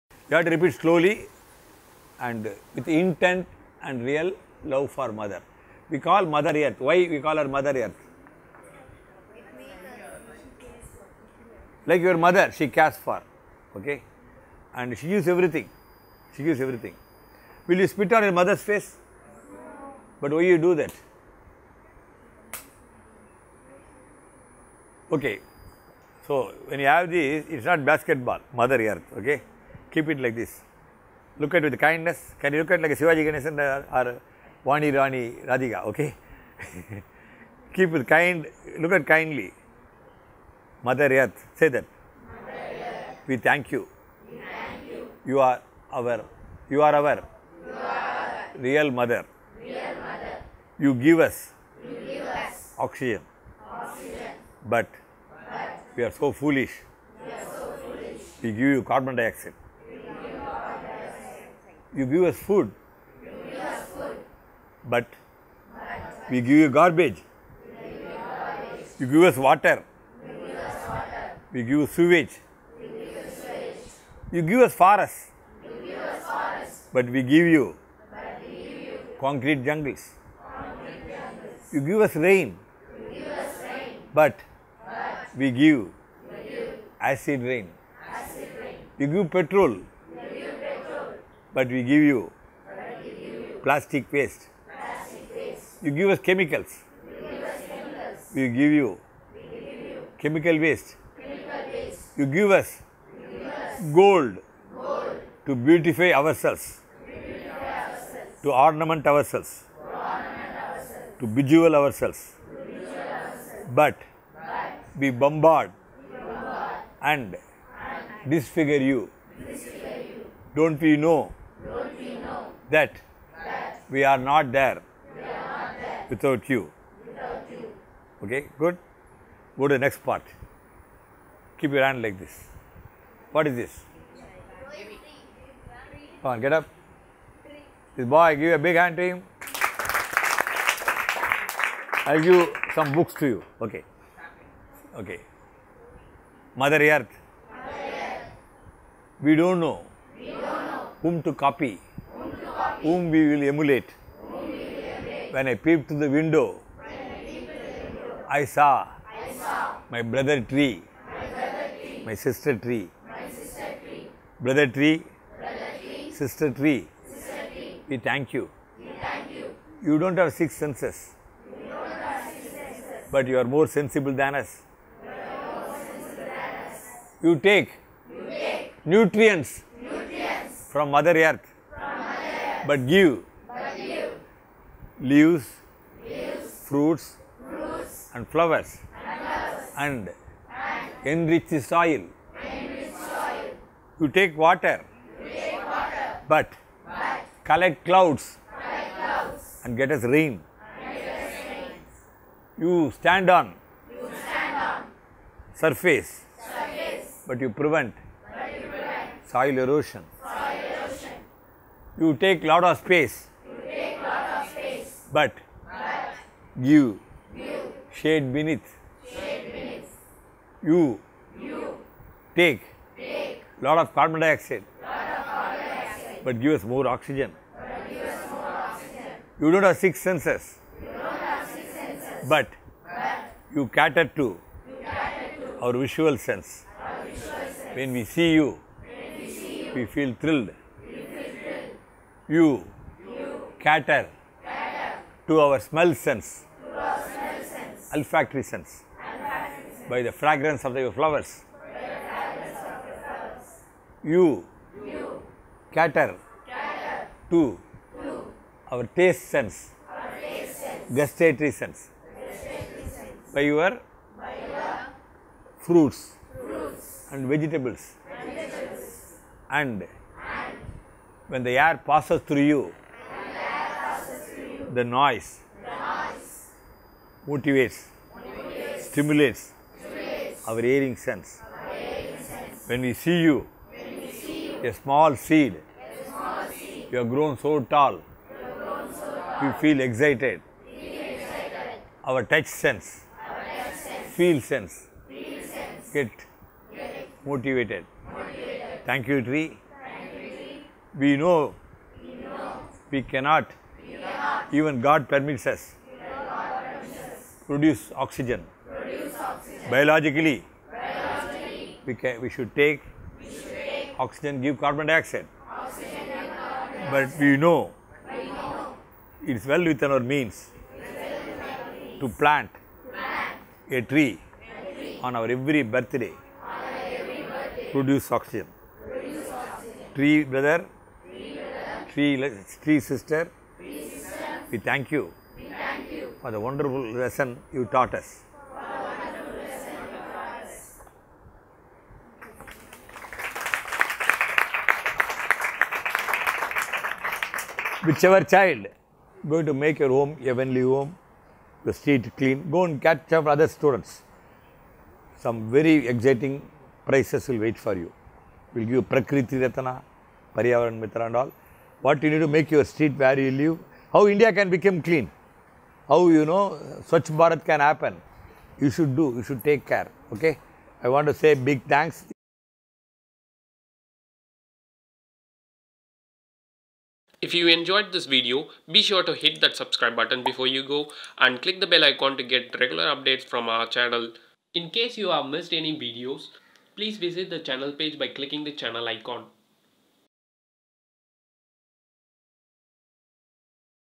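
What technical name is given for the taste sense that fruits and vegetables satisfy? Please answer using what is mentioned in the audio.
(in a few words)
Gustatory.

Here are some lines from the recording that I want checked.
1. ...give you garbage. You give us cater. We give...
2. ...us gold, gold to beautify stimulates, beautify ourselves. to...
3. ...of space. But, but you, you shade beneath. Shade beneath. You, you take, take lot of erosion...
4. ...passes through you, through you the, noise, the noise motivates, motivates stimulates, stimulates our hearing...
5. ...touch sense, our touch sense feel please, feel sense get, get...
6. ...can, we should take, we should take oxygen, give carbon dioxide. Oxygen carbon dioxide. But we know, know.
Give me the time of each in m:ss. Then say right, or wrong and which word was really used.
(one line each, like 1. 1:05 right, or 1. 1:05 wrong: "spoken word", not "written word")
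1. 1:06 wrong: "water", not "cater"
2. 1:43 wrong: "ourselves", not "stimulates"
3. 3:34 wrong: "carbon", not "erosion"
4. 4:31 right
5. 4:52 wrong: "sense", not "please"
6. 5:11 right.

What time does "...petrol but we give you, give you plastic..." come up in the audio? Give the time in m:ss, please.
1:29.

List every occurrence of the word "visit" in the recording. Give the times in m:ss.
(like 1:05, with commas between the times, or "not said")
6:26.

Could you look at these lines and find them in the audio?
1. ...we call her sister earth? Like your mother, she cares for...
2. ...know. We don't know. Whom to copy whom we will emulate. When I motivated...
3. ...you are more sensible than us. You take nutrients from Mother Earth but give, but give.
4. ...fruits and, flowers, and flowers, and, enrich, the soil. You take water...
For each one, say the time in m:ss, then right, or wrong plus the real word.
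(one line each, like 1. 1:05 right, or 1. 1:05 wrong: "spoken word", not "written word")
1. 0:07 wrong: "mother", not "sister"
2. 2:29 wrong: "peeped", not "motivated"
3. 2:53 right
4. 3:07 right.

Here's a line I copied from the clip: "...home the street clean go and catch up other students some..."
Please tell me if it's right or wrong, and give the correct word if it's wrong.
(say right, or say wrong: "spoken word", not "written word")
right.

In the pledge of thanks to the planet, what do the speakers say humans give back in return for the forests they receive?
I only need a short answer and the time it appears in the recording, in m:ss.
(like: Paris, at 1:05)
Concrete jungles, at 1:19.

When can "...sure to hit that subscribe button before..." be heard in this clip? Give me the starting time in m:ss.
6:18.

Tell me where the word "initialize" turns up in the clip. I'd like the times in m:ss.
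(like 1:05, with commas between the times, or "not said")
not said.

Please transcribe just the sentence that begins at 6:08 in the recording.
You should do, you should take care.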